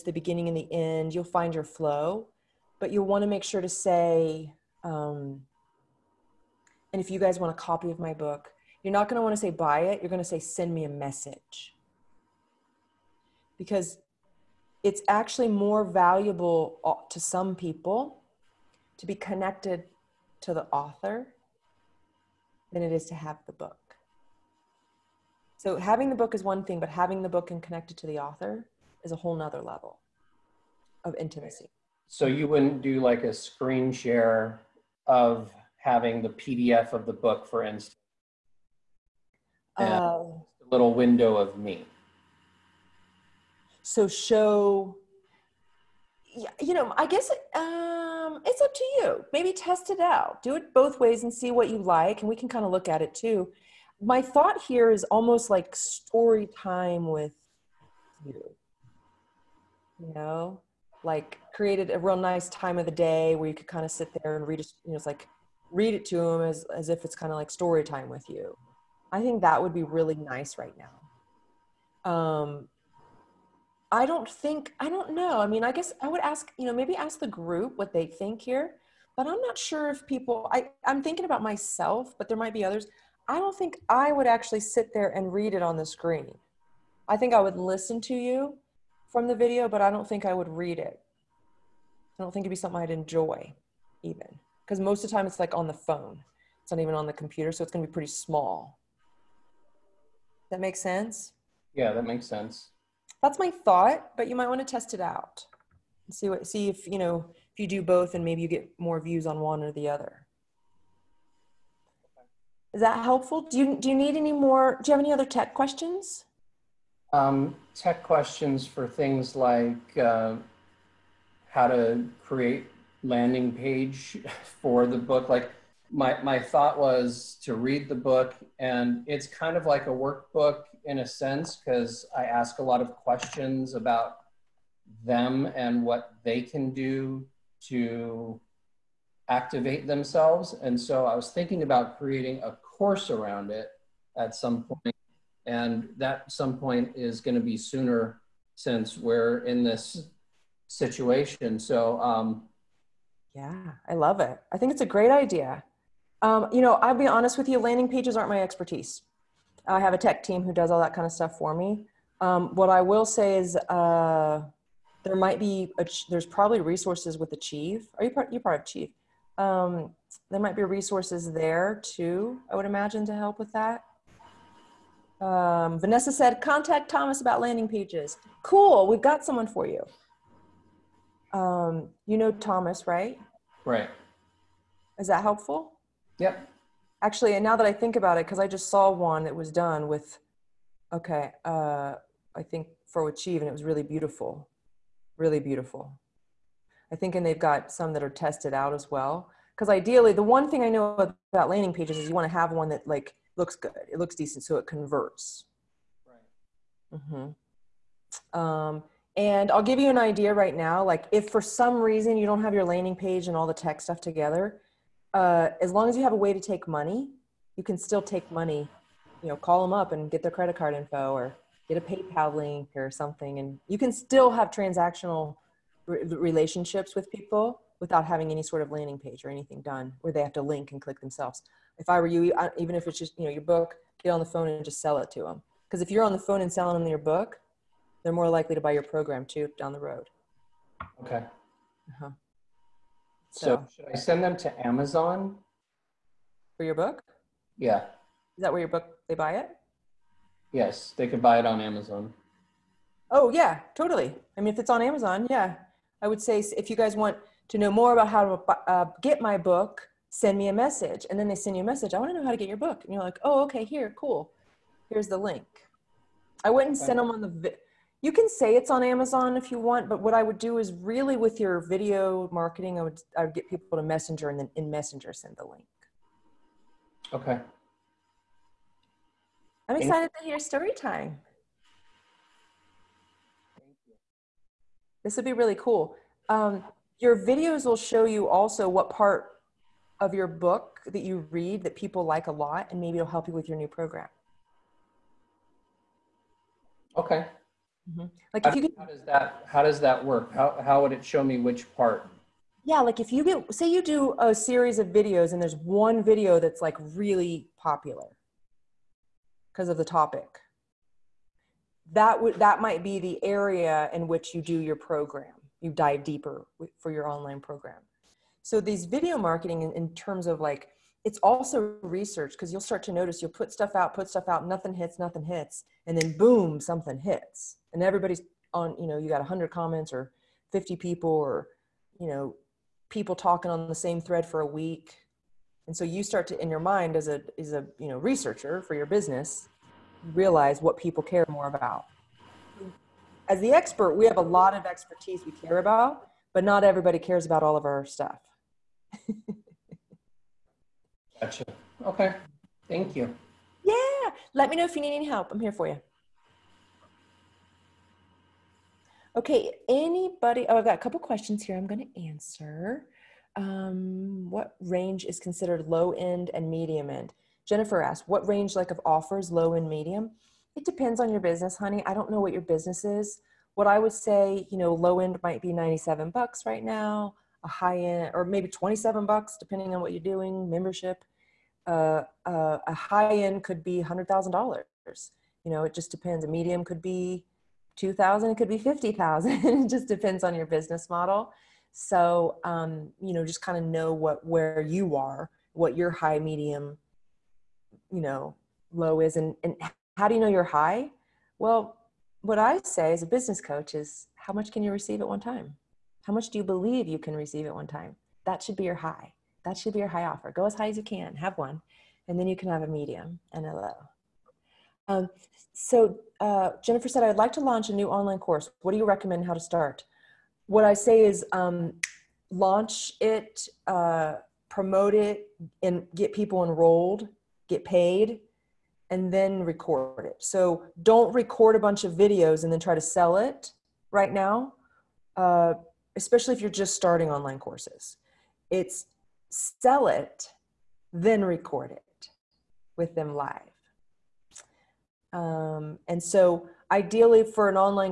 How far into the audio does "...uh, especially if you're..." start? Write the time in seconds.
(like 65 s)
435 s.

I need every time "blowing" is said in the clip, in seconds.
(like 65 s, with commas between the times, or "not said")
not said.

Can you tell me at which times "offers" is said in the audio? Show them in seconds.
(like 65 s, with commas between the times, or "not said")
368 s, 410 s.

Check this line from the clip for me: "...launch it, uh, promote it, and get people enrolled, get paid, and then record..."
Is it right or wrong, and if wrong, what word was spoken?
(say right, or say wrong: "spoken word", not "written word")
right.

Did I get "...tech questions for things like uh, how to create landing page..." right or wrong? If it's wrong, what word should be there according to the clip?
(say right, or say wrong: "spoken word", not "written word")
right.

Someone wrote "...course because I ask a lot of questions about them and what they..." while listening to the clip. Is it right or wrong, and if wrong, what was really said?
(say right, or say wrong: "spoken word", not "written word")
wrong: "sense", not "course".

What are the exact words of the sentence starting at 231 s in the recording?
If I were you, even if it's just you know your book, get on the phone and just sell it to them.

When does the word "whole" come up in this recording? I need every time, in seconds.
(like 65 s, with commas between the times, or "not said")
29 s.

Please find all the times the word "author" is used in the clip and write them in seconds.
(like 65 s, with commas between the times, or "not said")
20 s, 28 s.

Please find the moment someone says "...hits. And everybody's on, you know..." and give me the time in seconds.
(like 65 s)
326 s.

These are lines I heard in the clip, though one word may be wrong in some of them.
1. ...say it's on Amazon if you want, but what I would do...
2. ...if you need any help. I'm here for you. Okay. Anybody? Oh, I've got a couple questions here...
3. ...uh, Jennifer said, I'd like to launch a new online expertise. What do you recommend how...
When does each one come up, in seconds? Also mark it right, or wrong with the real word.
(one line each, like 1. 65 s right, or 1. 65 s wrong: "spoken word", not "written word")
1. 268 s right
2. 354 s right
3. 416 s wrong: "course", not "expertise".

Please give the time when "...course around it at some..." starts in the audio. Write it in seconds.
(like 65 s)
142 s.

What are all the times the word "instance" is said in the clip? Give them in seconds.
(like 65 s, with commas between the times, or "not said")
37 s.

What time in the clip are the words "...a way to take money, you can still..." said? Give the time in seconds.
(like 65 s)
216 s.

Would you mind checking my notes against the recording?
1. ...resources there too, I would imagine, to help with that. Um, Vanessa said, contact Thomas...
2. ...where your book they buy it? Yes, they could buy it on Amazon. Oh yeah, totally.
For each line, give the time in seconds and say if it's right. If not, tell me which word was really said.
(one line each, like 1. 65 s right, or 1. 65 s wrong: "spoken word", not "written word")
1. 170 s right
2. 248 s right.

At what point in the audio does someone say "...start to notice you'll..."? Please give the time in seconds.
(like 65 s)
322 s.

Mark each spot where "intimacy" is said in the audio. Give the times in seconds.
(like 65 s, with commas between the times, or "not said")
31 s.